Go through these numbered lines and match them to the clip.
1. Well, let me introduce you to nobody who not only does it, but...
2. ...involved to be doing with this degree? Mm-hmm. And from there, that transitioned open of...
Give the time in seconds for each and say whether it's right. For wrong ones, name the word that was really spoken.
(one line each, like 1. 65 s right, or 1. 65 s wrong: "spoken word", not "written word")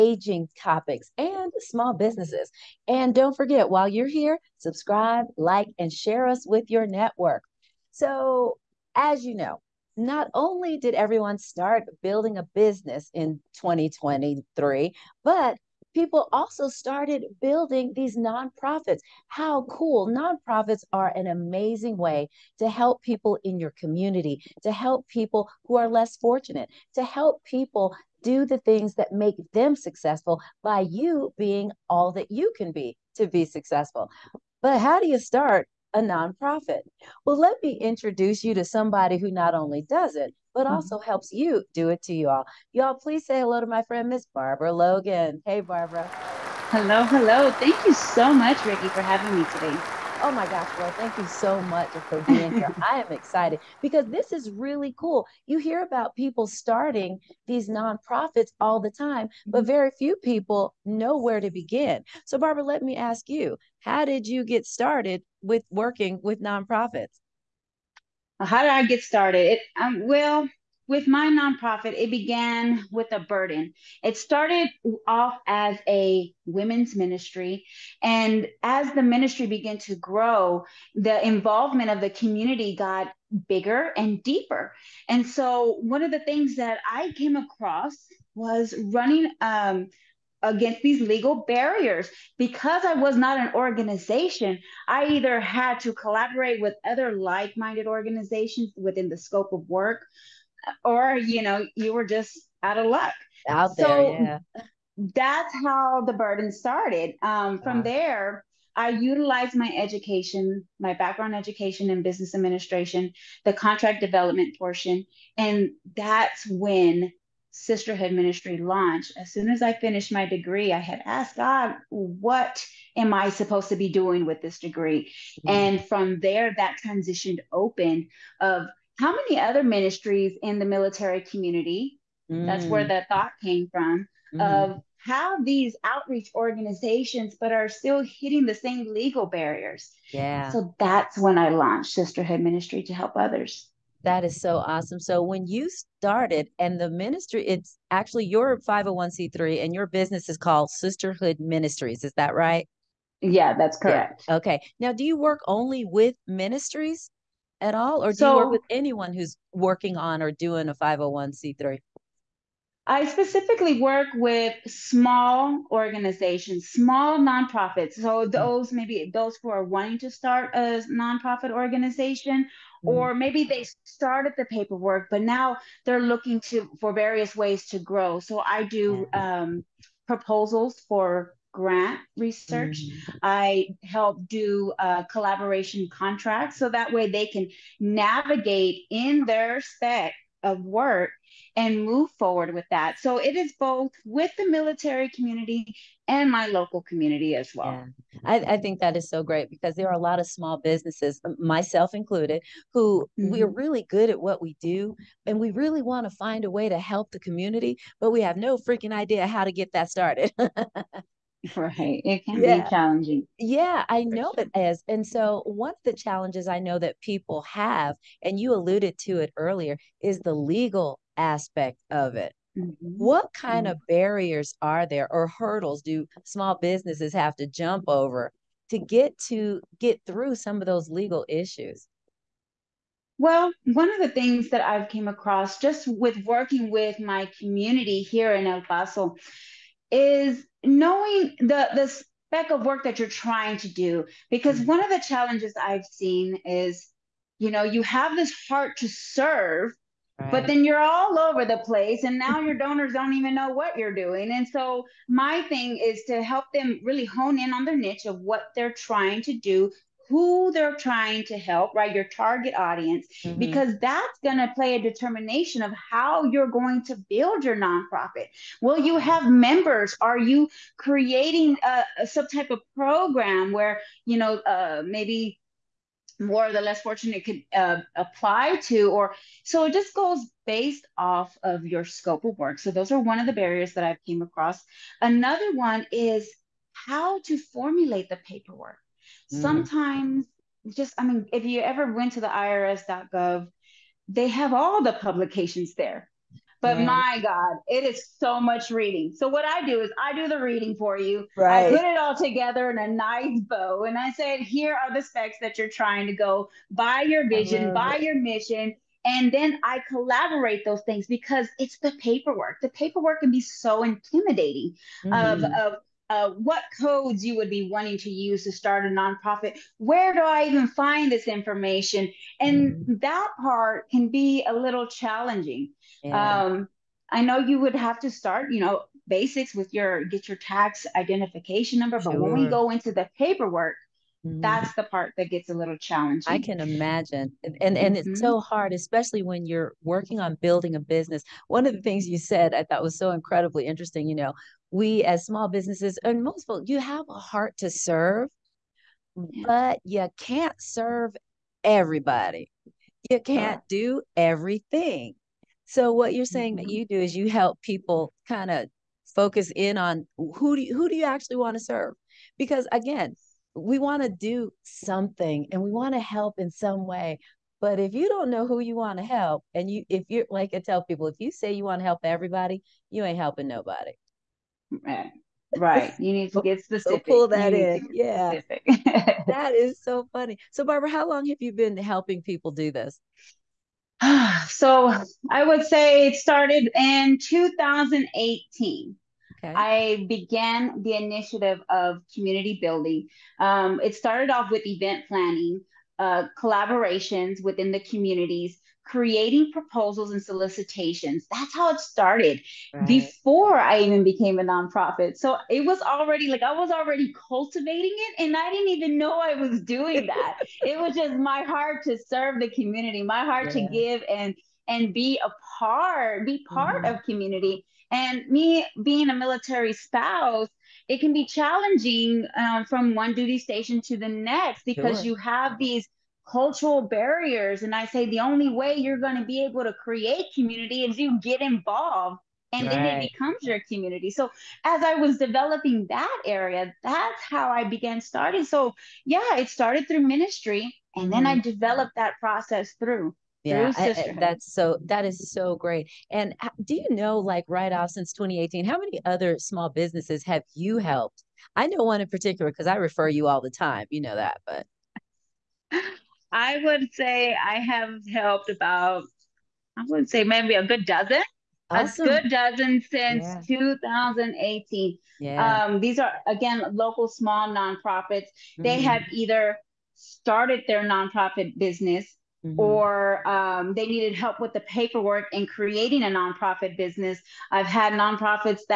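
1. 37 s wrong: "somebody", not "nobody"
2. 123 s wrong: "supposed", not "involved".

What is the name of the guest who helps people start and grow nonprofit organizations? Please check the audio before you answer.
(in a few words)
Barbara Logan.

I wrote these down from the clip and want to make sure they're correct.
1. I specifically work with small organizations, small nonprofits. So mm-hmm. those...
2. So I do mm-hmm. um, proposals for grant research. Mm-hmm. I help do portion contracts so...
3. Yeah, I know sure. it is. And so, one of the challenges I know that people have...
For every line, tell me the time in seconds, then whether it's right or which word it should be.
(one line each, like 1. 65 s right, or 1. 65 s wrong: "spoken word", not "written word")
1. 162 s right
2. 178 s wrong: "collaboration", not "portion"
3. 213 s right.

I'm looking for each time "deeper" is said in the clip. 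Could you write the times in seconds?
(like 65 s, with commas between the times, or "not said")
84 s.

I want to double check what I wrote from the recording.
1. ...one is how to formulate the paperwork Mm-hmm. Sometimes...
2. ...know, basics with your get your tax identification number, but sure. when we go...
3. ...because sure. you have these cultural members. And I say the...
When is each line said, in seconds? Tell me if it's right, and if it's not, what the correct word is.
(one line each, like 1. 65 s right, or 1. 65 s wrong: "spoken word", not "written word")
1. 285 s right
2. 328 s right
3. 424 s wrong: "barriers", not "members".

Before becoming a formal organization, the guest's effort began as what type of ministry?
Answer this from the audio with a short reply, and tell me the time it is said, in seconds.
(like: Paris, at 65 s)
women's ministry, at 76 s.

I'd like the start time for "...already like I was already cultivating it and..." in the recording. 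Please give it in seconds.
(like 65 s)
405 s.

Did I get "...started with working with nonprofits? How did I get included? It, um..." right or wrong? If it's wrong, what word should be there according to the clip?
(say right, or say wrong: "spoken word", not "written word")
wrong: "started", not "included".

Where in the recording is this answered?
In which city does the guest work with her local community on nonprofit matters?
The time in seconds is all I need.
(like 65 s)
238 s.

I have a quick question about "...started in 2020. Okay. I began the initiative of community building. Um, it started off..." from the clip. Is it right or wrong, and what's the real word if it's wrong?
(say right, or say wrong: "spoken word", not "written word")
wrong: "2018", not "2020".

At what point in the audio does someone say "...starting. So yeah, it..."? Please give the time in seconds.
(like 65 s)
437 s.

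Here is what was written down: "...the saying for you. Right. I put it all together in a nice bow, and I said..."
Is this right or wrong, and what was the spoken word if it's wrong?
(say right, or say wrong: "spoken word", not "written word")
wrong: "reading", not "saying".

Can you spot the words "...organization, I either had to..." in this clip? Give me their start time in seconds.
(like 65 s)
93 s.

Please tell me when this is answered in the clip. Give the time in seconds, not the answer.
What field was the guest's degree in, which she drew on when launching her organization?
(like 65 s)
112 s.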